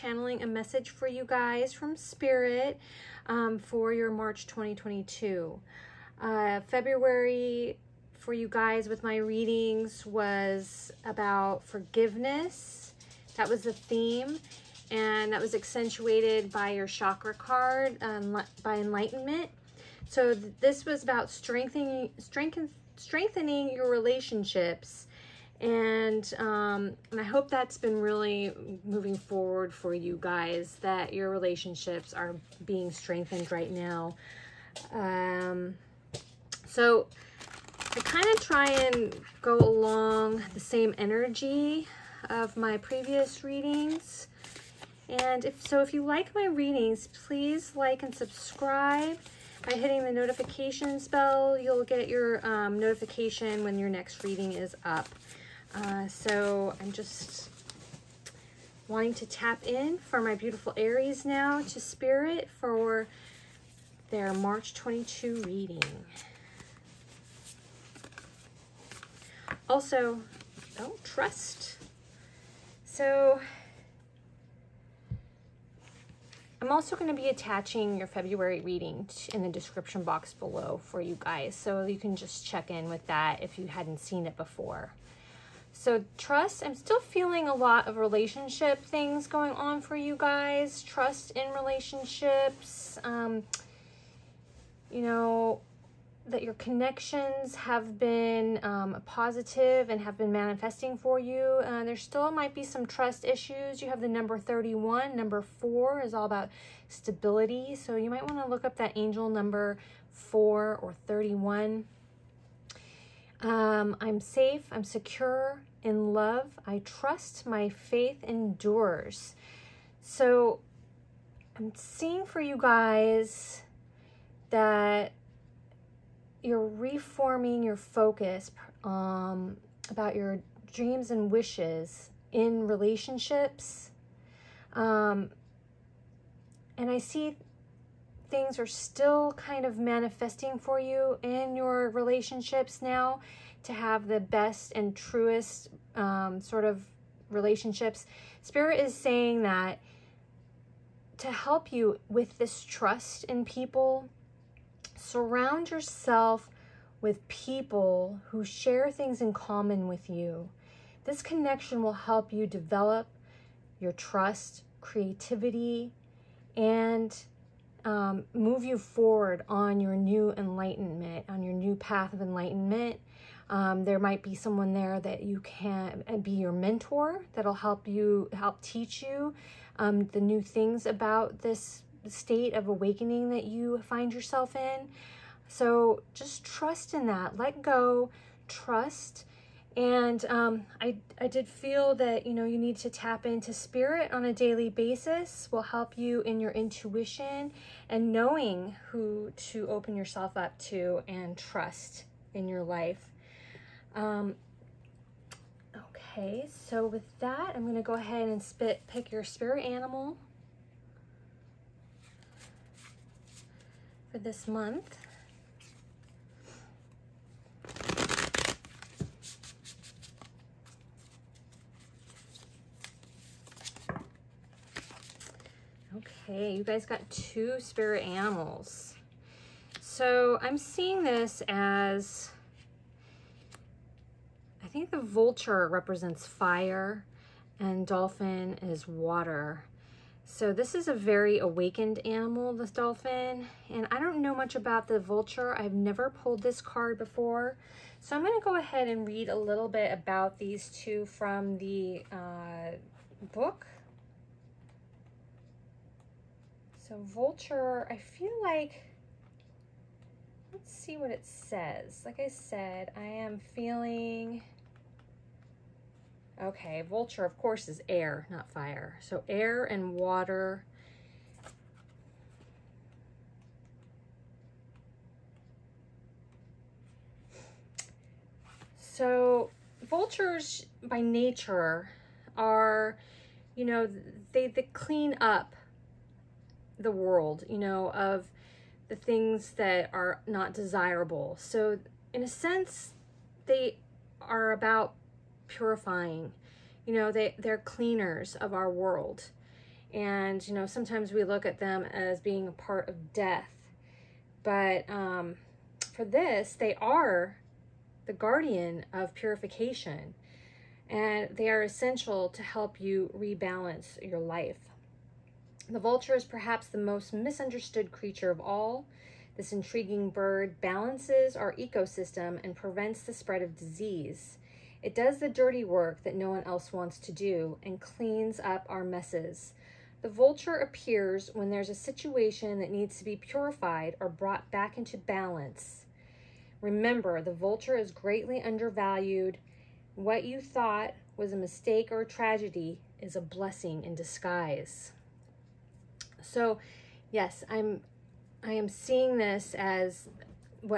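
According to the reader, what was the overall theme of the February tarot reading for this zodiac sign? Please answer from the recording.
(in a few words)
Forgiveness.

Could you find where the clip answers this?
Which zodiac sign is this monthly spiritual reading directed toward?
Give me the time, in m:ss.
1:00.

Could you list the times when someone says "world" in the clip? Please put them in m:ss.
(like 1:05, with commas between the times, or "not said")
4:46, 4:58.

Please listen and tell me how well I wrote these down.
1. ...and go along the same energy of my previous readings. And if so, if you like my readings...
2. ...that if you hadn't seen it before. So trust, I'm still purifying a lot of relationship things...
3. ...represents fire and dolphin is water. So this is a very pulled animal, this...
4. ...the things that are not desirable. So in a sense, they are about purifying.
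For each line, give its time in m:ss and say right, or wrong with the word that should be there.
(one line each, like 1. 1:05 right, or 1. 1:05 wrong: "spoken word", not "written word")
1. 0:38 right
2. 1:23 wrong: "feeling", not "purifying"
3. 3:55 wrong: "awakened", not "pulled"
4. 4:48 right.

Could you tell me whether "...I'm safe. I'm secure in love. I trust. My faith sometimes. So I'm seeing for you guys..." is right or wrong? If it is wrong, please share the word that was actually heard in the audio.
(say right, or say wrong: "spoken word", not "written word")
wrong: "endures", not "sometimes".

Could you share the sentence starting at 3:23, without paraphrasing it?
Um, okay, so with that, I'm going to go ahead and spit pick your spirit animal for this month.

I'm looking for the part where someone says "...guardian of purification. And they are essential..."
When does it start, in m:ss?
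5:08.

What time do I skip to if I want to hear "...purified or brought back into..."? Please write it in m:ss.
5:33.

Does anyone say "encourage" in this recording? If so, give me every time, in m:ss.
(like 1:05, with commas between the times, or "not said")
not said.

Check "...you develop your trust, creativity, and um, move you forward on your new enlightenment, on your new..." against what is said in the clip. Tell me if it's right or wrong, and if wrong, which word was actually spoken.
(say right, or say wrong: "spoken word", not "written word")
right.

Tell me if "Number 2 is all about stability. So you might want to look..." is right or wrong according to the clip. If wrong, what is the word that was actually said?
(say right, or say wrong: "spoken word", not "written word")
wrong: "4", not "2".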